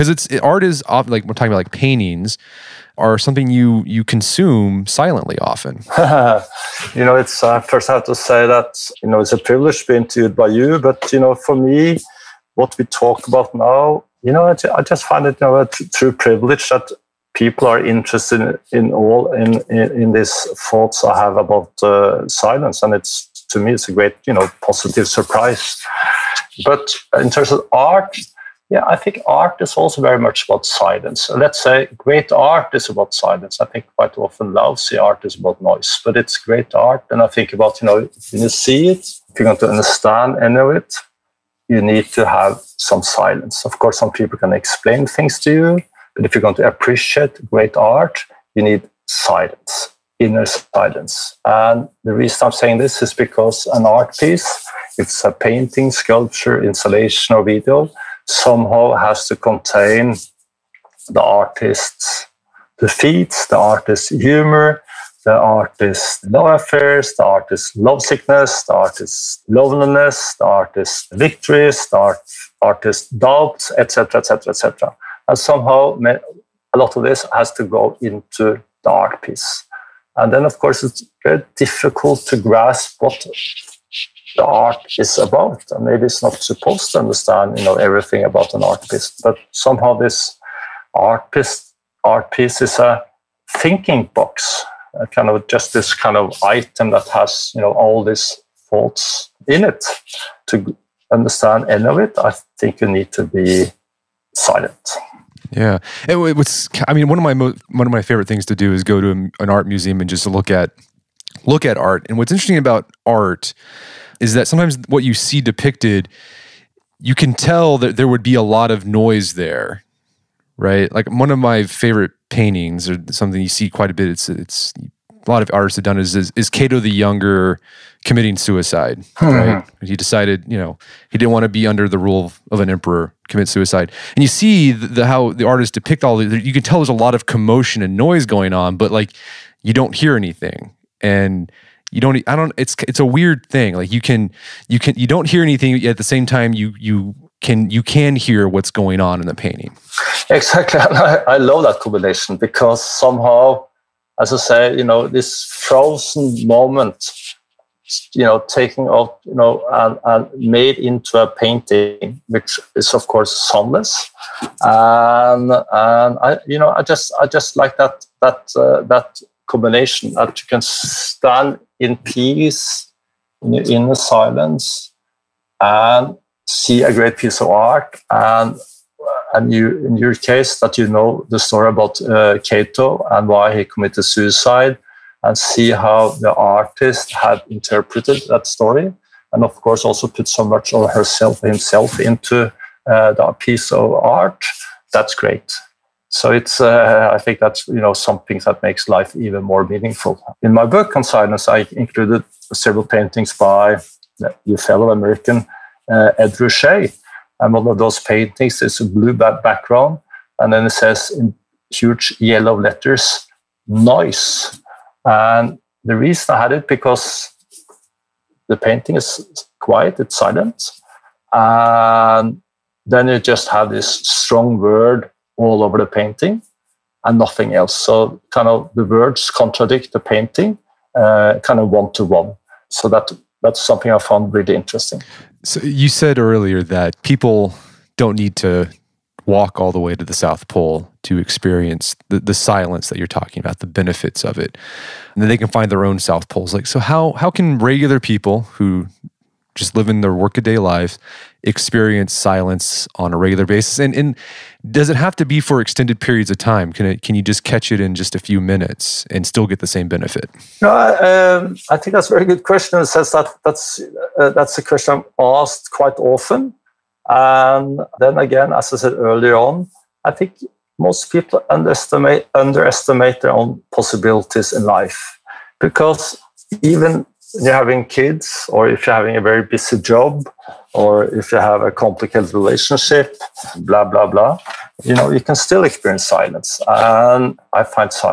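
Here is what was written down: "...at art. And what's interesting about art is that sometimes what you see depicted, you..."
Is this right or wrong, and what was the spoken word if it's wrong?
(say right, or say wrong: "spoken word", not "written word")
right.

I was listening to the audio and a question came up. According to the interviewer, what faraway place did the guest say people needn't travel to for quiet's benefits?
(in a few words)
the South Pole.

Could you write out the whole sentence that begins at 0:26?
But in terms of art, yeah, I think art is also very much about silence.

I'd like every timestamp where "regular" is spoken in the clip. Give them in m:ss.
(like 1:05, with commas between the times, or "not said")
4:07, 4:13.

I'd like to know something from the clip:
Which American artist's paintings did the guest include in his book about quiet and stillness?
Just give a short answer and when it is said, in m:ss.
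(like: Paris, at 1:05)
Ed Ruscha, at 3:26.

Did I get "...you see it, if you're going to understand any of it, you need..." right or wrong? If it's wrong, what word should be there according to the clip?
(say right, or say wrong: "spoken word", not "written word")
right.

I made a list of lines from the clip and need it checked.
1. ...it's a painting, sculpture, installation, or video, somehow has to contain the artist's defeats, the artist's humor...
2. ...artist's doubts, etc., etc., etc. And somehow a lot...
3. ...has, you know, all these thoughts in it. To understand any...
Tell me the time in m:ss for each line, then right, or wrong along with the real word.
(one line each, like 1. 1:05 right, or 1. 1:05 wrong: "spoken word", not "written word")
1. 0:54 right
2. 1:12 right
3. 1:37 right.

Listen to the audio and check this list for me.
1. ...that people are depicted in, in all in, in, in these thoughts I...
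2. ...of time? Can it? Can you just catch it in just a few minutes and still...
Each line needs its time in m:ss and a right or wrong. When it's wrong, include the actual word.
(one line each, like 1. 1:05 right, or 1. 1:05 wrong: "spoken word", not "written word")
1. 0:16 wrong: "interested", not "depicted"
2. 4:16 right.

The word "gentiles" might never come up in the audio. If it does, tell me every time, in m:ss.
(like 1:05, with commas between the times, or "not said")
not said.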